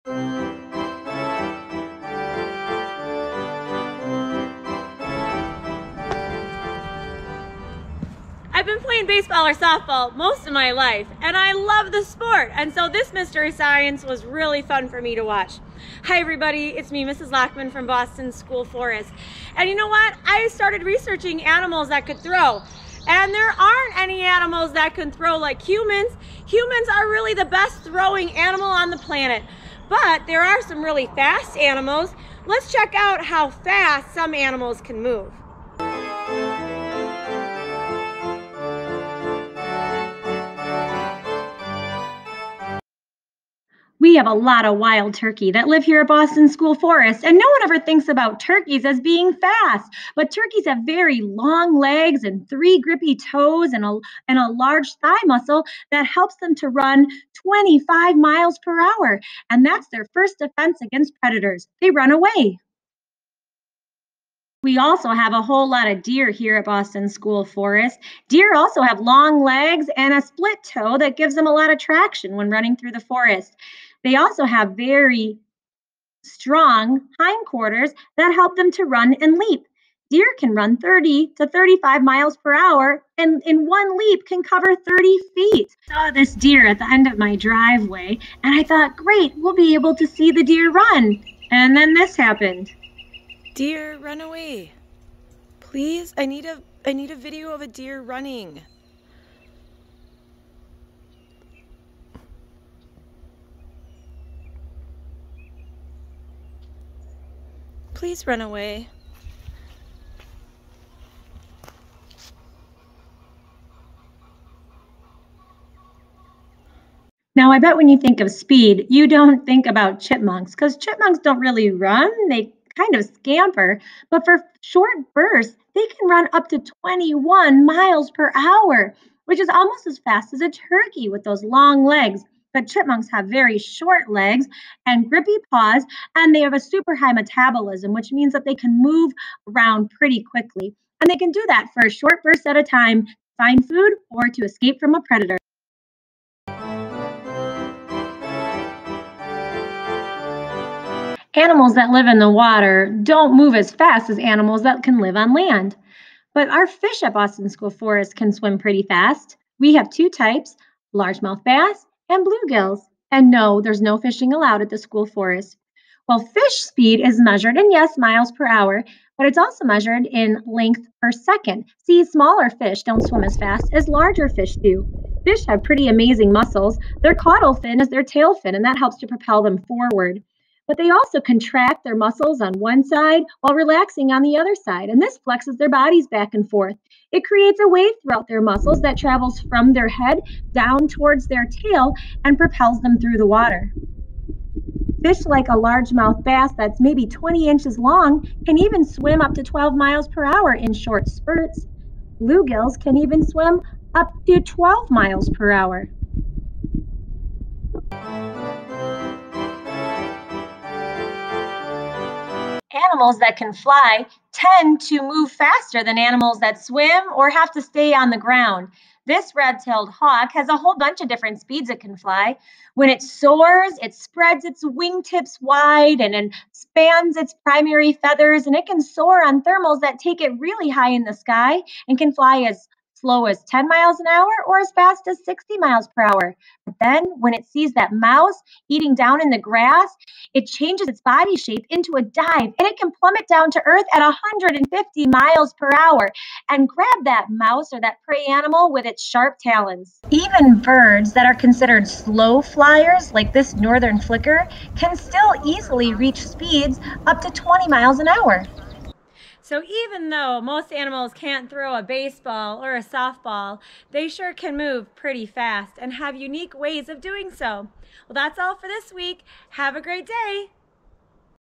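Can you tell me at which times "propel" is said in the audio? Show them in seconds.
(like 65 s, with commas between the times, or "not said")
179 s, 192 s.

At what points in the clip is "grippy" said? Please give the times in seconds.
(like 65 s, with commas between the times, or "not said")
52 s, 135 s.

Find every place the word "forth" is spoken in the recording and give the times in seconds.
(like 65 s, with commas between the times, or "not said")
186 s.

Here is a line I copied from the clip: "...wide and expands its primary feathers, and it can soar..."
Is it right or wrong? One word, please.
right.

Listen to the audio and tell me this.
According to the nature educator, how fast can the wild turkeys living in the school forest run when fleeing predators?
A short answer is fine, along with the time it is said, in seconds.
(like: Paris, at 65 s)
25 mph, at 57 s.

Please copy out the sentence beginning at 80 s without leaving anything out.
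Deer can run 30 to 35 miles per hour and in one leap can cover 30 feet.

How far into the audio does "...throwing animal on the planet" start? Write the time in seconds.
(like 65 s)
27 s.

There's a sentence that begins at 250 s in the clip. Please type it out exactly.
Even birds that are considered slow flyers, like this northern flicker, can still easily reach speeds up to 20 miles an hour.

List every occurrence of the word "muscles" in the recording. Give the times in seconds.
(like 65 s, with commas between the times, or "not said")
55 s, 176 s, 181 s, 188 s.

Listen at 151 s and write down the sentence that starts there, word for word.
Animals that live in the water don't move as fast as animals that can live on land.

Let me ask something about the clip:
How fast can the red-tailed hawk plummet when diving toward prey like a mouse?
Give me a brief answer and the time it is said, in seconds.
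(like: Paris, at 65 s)
150 mph, at 244 s.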